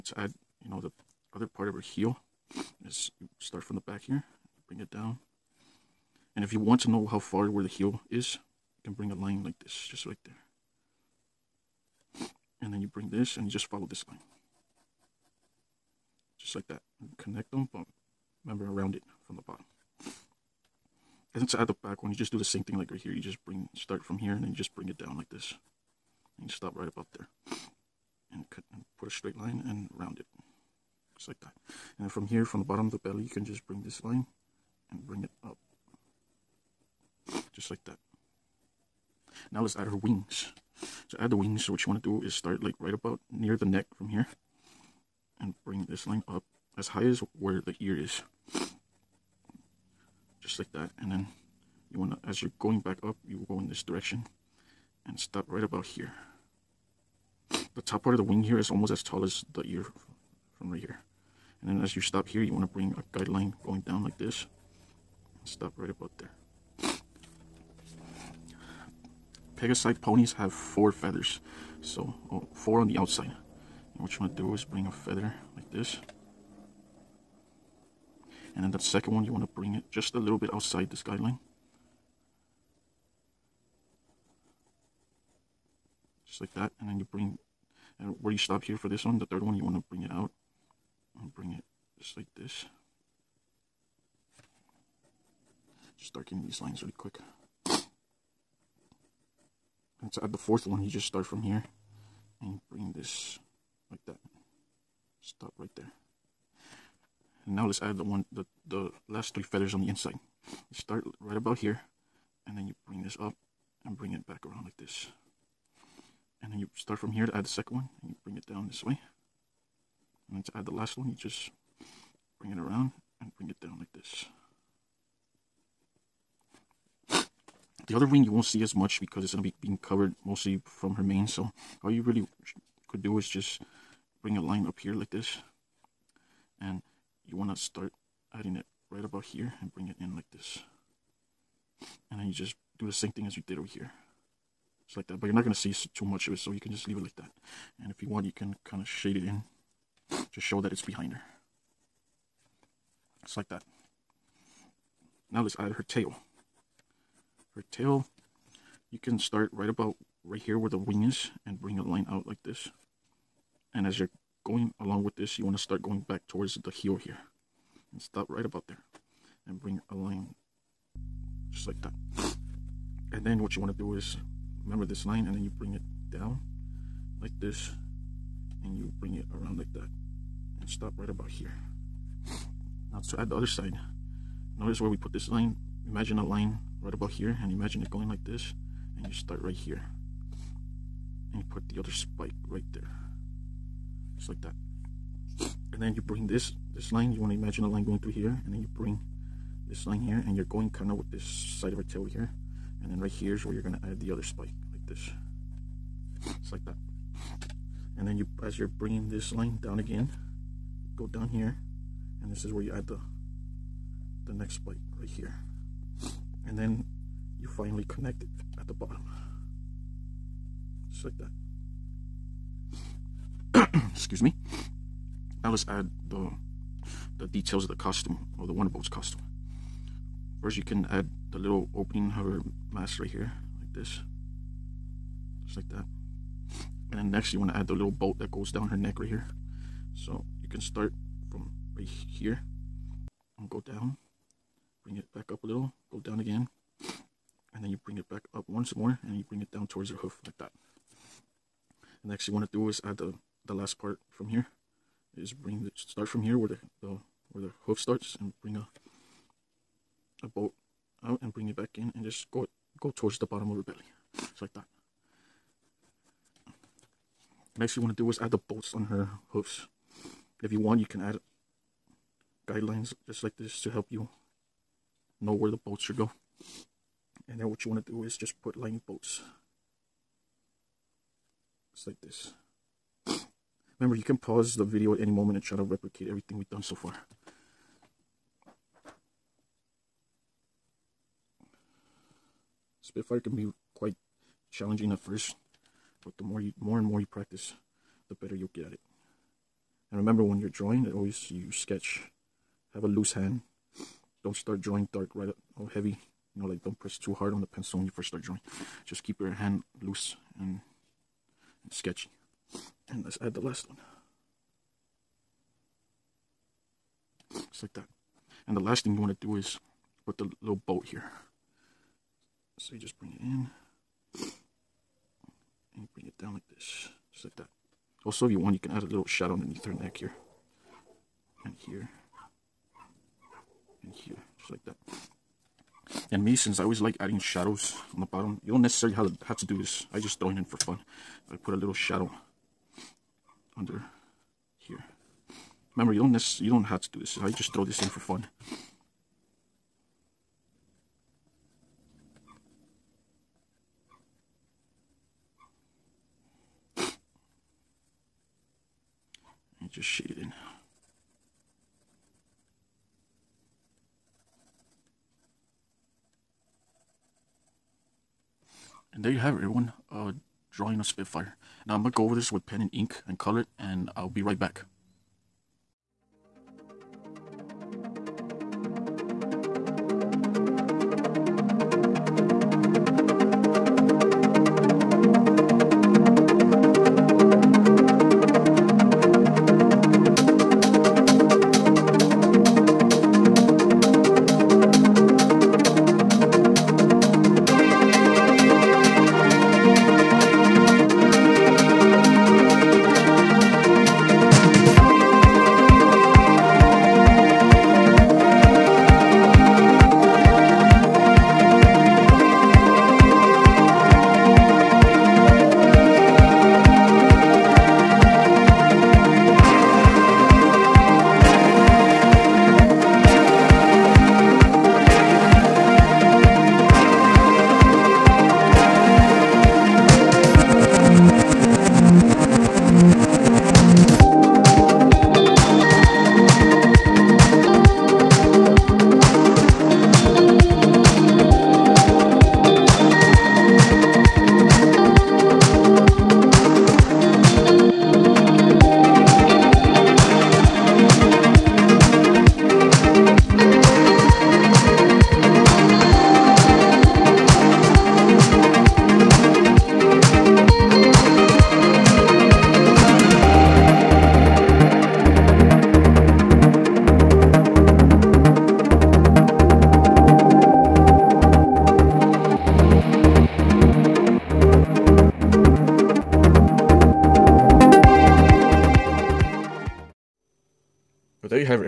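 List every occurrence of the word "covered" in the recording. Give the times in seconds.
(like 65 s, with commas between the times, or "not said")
129 s.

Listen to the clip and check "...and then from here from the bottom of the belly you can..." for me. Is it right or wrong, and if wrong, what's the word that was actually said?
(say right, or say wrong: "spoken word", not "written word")
right.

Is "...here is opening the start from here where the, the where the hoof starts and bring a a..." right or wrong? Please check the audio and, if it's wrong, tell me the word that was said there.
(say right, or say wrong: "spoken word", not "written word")
wrong: "bring", not "opening".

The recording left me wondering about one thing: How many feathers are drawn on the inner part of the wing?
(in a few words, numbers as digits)
3.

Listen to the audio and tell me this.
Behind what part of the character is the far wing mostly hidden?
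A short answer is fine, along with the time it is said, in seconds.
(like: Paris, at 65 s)
Her mane, at 129 s.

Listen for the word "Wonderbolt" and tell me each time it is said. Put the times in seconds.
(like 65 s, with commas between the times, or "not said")
228 s.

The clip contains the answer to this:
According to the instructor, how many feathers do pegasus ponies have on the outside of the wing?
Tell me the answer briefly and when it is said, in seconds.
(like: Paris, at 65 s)
4, at 72 s.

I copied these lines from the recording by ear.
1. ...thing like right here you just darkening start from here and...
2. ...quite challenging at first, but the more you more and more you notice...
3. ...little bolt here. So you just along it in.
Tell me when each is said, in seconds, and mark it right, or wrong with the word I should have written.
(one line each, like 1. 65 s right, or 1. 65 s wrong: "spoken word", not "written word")
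1. 22 s wrong: "bring", not "darkening"
2. 293 s wrong: "practice", not "notice"
3. 320 s wrong: "bring", not "along".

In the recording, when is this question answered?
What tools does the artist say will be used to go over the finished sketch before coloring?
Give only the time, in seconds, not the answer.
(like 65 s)
372 s.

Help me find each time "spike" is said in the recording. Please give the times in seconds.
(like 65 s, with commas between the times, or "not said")
191 s, 204 s, 214 s.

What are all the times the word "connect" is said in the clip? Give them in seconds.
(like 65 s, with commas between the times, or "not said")
17 s, 217 s.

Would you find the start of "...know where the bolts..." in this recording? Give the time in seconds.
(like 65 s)
275 s.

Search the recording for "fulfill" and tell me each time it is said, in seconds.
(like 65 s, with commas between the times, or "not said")
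not said.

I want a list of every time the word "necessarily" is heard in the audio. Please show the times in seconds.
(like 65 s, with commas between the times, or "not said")
338 s.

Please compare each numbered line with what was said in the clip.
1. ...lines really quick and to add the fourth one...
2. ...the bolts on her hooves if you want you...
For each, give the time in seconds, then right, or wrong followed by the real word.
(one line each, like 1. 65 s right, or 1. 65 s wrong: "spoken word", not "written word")
1. 96 s right
2. 268 s right.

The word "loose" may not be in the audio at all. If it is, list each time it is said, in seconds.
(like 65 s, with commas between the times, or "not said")
302 s, 309 s.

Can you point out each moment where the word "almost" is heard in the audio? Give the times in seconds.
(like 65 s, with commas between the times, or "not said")
58 s.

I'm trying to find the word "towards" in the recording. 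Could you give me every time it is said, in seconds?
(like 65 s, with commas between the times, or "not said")
166 s, 249 s, 262 s.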